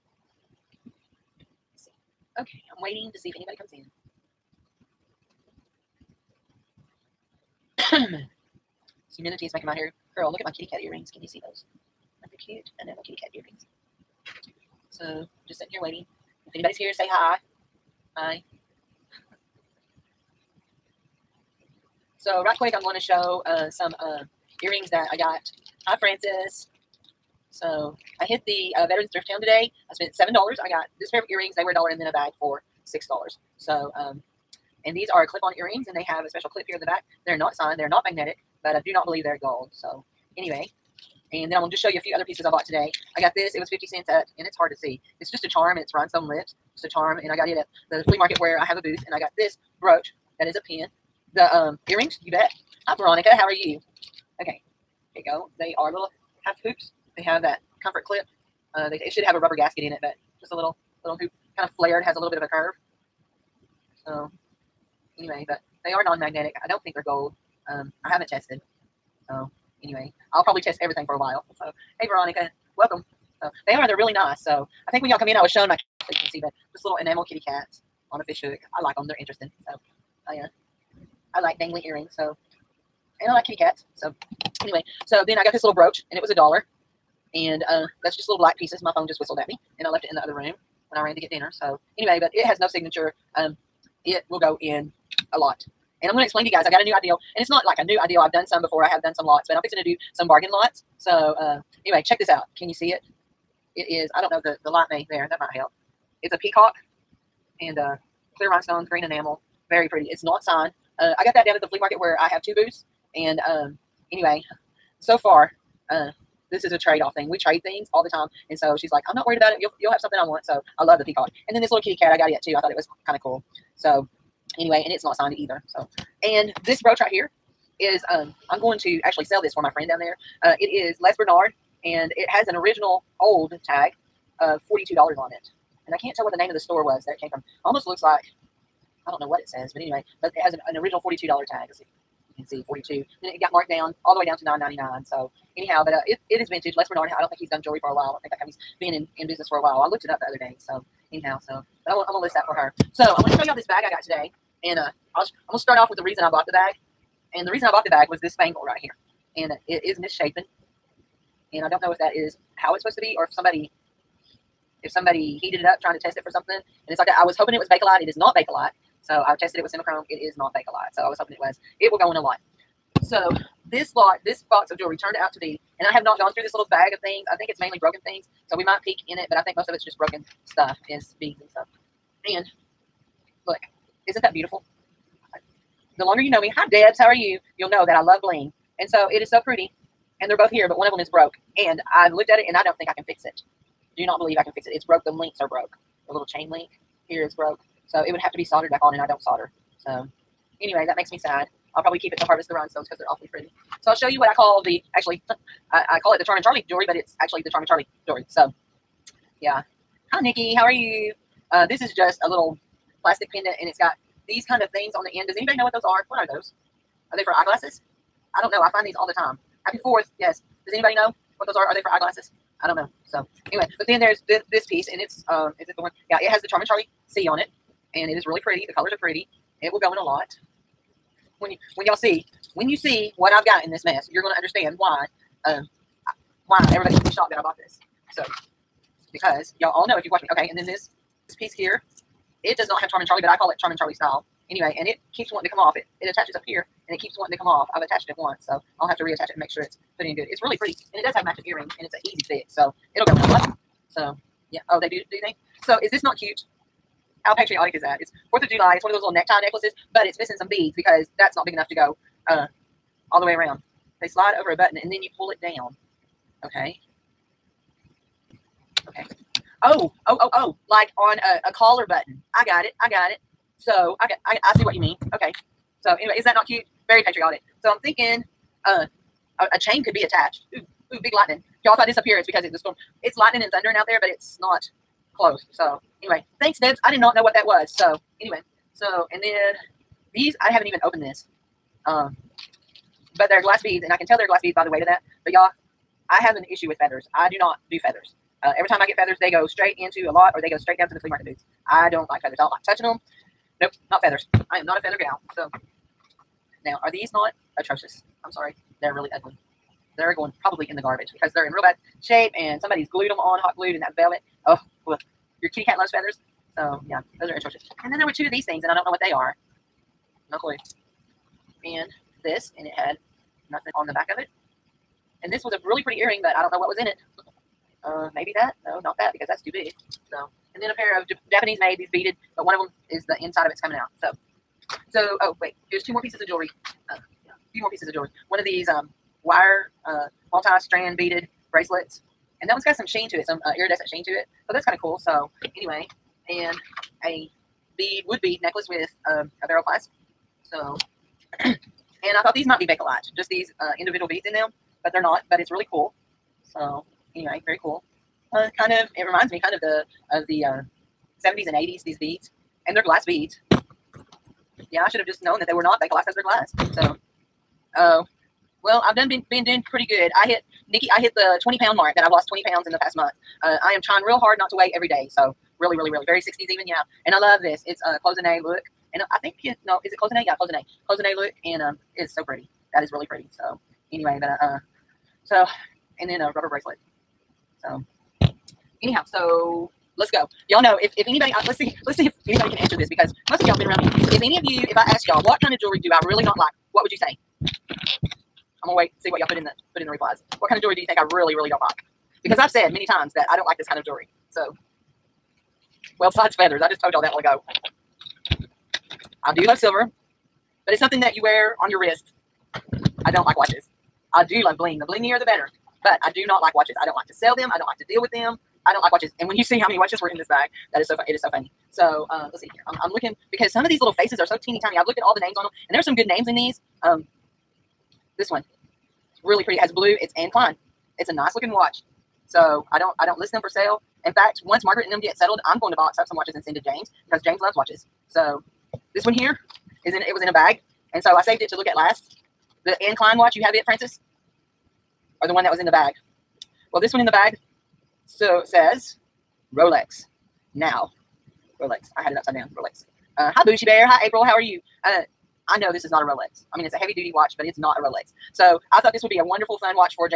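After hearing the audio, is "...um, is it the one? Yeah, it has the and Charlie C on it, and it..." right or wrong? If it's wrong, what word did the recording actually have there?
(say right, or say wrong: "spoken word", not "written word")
right.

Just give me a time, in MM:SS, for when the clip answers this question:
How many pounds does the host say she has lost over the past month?
06:11.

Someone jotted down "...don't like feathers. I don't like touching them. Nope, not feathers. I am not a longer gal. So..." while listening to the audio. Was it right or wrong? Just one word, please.
wrong.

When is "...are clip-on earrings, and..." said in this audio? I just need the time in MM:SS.
00:35.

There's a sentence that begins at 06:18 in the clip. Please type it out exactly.
And I, I think, you know, is it cloisonne?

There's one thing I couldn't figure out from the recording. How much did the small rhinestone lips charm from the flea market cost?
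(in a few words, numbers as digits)
50 cents.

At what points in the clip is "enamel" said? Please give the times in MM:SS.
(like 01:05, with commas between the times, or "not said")
01:16, 01:49.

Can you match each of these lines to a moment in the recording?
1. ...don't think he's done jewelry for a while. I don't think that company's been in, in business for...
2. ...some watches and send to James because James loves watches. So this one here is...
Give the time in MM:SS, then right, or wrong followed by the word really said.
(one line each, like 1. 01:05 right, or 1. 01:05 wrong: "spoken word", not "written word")
1. 02:27 right
2. 07:16 right.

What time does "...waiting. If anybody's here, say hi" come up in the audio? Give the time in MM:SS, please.
00:15.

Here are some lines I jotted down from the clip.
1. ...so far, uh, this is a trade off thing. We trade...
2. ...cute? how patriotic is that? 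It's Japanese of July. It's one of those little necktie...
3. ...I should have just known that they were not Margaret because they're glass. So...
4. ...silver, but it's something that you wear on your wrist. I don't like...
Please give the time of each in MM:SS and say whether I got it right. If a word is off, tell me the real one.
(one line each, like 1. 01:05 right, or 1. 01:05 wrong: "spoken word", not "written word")
1. 01:54 right
2. 04:16 wrong: "Fourth", not "Japanese"
3. 06:04 wrong: "Bakelite", not "Margaret"
4. 06:49 right.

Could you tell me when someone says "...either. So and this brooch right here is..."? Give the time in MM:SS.
02:05.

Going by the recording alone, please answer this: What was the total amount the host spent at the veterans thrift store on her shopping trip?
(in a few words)
$7.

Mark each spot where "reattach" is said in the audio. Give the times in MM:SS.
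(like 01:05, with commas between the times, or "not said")
04:09.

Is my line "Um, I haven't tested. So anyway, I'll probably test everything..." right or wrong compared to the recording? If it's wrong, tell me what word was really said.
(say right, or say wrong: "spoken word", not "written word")
right.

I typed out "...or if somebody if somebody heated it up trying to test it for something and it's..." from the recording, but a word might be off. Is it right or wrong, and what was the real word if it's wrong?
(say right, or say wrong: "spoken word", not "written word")
right.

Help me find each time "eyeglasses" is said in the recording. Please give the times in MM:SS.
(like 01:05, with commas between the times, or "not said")
03:37, 03:41.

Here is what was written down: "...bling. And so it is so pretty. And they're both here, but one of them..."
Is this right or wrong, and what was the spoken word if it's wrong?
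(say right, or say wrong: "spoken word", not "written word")
right.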